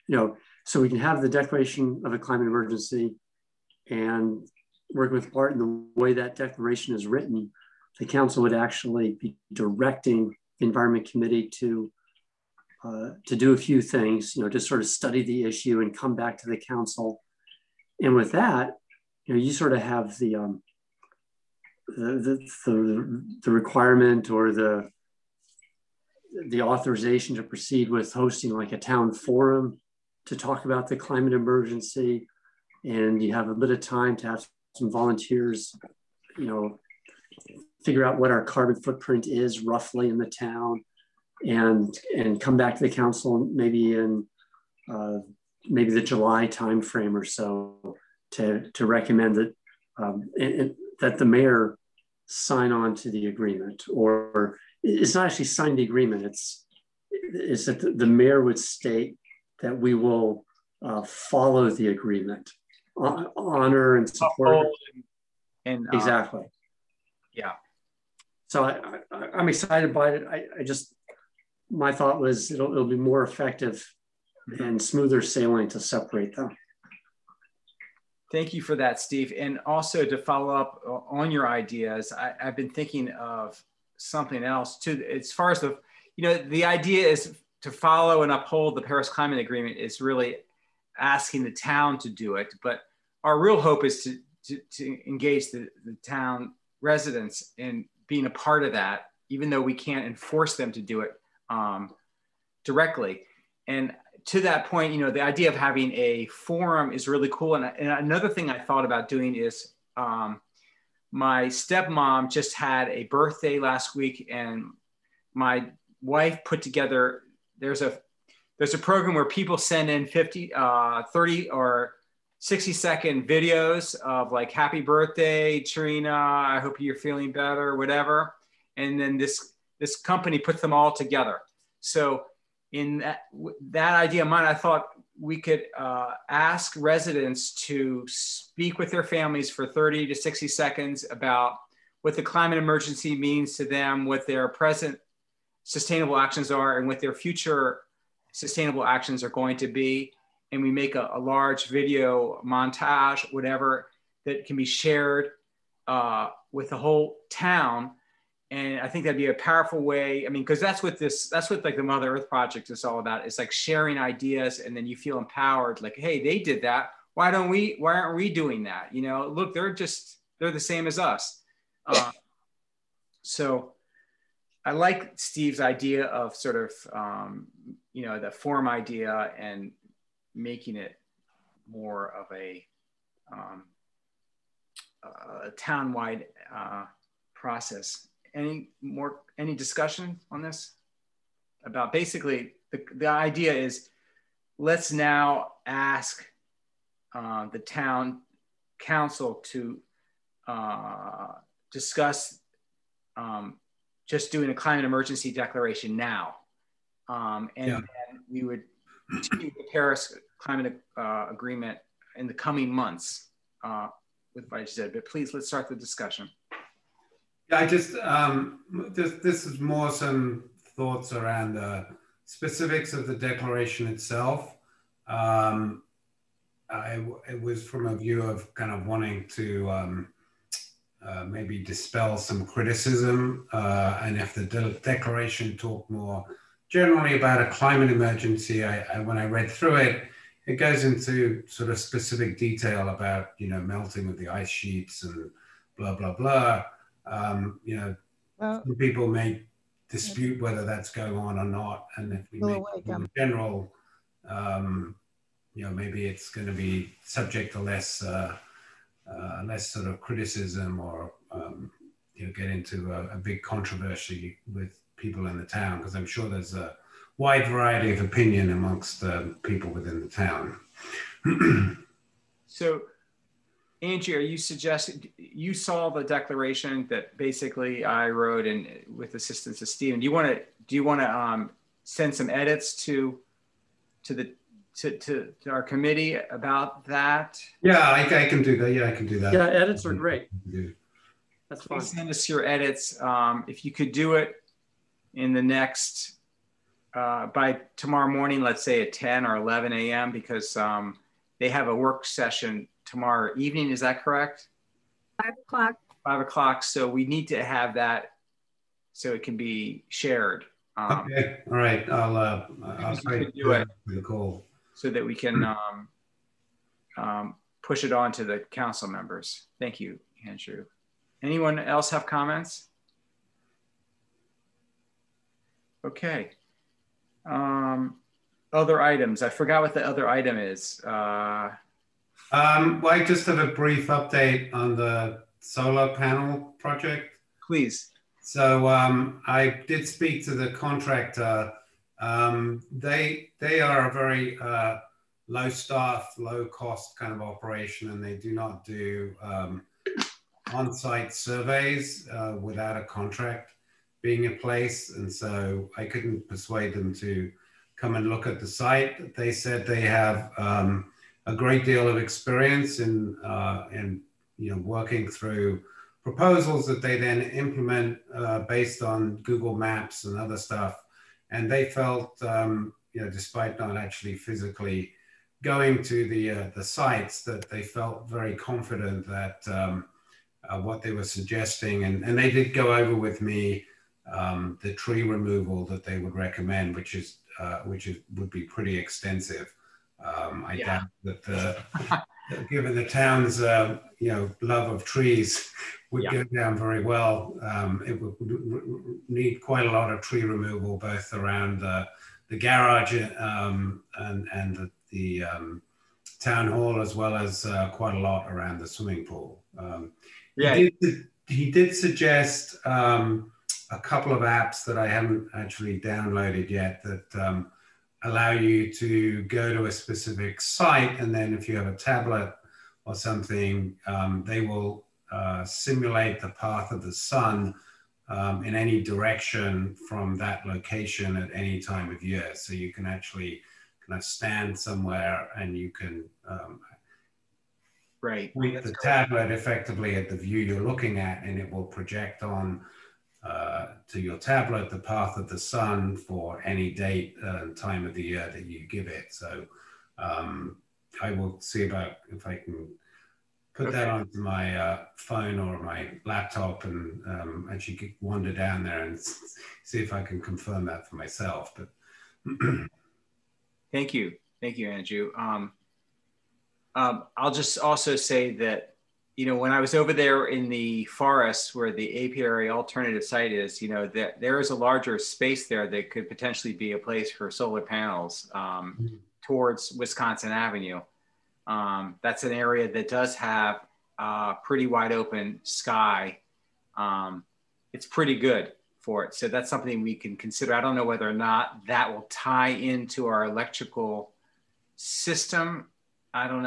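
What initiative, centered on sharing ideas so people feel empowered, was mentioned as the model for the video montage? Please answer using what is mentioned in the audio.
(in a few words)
mother earth project.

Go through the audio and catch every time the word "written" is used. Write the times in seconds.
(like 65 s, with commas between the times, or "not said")
7 s.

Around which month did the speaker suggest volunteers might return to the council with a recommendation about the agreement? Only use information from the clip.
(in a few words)
July.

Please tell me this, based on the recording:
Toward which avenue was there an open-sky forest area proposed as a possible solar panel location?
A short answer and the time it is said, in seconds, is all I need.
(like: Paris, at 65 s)
Wisconsin Avenue, at 479 s.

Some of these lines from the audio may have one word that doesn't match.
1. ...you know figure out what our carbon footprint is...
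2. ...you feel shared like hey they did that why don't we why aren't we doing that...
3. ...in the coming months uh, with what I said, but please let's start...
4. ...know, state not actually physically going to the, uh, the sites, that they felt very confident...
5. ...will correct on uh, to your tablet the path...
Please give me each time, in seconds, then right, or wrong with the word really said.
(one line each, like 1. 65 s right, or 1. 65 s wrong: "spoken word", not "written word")
1. 36 s right
2. 164 s wrong: "empowered", not "shared"
3. 212 s right
4. 373 s wrong: "despite", not "state"
5. 441 s wrong: "project", not "correct".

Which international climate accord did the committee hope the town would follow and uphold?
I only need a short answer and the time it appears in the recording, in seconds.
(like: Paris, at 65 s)
Paris Climate Agreement, at 88 s.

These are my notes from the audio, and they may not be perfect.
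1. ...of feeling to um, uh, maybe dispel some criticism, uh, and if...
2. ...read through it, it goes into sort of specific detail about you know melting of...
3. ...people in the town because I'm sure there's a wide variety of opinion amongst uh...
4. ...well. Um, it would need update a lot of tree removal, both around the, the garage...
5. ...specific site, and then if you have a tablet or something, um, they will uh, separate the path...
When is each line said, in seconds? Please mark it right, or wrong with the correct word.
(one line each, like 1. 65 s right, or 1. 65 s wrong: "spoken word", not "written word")
1. 228 s wrong: "wanting", not "feeling"
2. 239 s right
3. 264 s right
4. 396 s wrong: "quite", not "update"
5. 419 s wrong: "simulate", not "separate".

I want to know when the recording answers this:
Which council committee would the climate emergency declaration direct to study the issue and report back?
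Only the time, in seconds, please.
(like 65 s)
10 s.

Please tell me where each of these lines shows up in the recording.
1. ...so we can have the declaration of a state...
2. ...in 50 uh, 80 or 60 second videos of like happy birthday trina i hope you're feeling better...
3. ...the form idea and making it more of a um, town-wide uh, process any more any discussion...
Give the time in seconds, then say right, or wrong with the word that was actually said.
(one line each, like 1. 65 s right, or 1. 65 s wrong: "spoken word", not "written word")
1. 0 s wrong: "climate", not "state"
2. 119 s wrong: "30", not "80"
3. 178 s right.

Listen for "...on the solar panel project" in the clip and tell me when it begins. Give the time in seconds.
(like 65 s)
334 s.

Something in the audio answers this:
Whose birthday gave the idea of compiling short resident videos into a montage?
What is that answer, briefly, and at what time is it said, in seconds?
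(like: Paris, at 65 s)
stepmom, at 111 s.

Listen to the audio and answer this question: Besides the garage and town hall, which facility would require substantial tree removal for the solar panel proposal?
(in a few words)
swimming pool.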